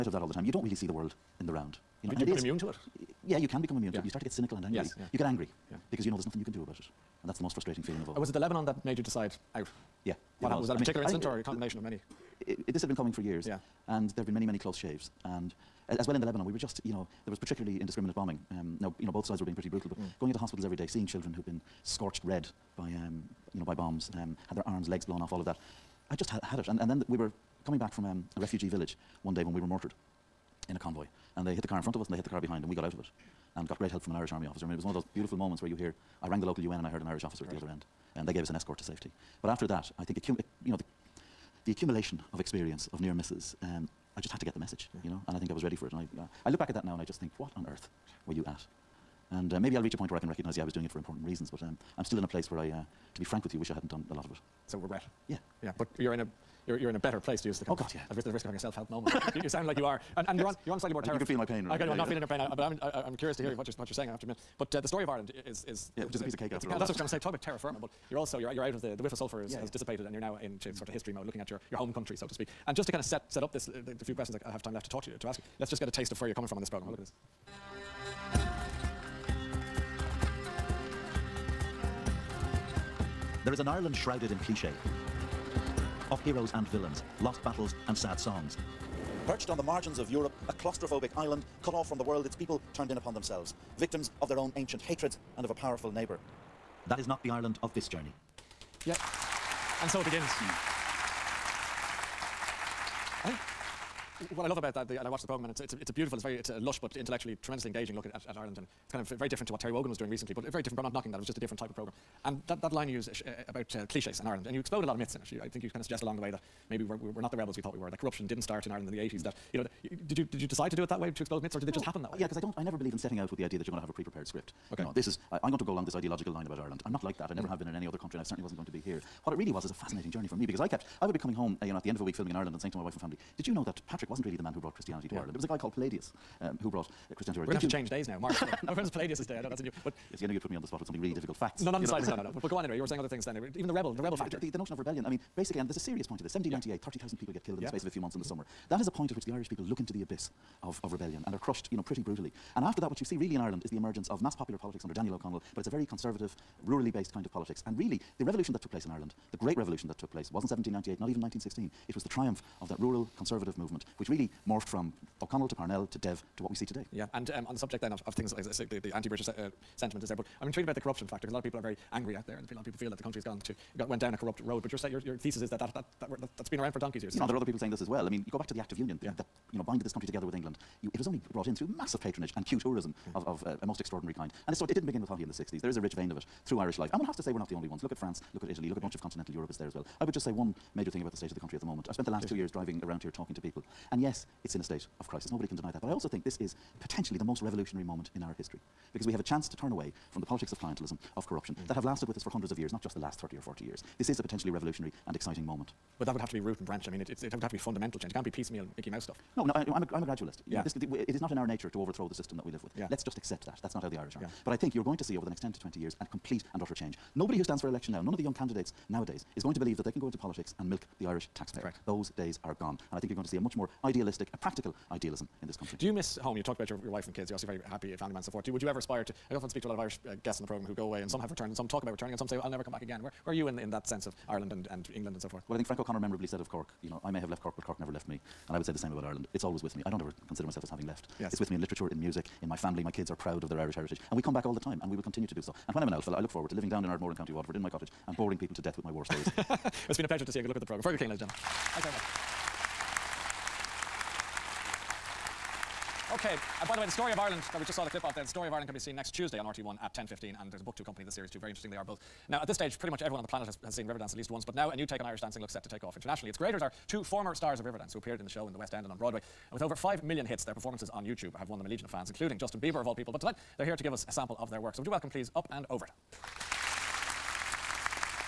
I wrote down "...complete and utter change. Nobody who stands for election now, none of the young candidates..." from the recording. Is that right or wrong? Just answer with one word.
right.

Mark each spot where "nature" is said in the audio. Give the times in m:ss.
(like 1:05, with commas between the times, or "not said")
3:31.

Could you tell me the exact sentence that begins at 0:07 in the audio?
And that's the most frustrating feeling of all.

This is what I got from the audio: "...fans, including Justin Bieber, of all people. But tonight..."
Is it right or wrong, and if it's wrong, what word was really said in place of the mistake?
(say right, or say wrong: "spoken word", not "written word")
right.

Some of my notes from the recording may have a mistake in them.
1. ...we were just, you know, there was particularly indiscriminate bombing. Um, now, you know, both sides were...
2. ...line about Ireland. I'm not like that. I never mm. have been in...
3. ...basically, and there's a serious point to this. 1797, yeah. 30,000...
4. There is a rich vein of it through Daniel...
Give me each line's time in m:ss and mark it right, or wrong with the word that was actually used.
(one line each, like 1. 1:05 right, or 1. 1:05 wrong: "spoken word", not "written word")
1. 0:16 right
2. 2:06 right
3. 2:25 wrong: "1798", not "1797"
4. 3:05 wrong: "Irish", not "Daniel".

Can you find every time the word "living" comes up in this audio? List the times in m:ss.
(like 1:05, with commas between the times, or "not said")
4:06.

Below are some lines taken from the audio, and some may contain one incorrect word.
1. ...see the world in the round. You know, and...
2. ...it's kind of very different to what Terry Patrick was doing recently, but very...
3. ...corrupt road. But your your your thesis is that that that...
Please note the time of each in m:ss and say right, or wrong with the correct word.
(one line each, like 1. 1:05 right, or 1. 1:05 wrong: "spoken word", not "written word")
1. 0:00 right
2. 1:48 wrong: "Wogan", not "Patrick"
3. 2:54 right.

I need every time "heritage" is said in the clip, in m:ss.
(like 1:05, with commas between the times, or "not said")
4:03.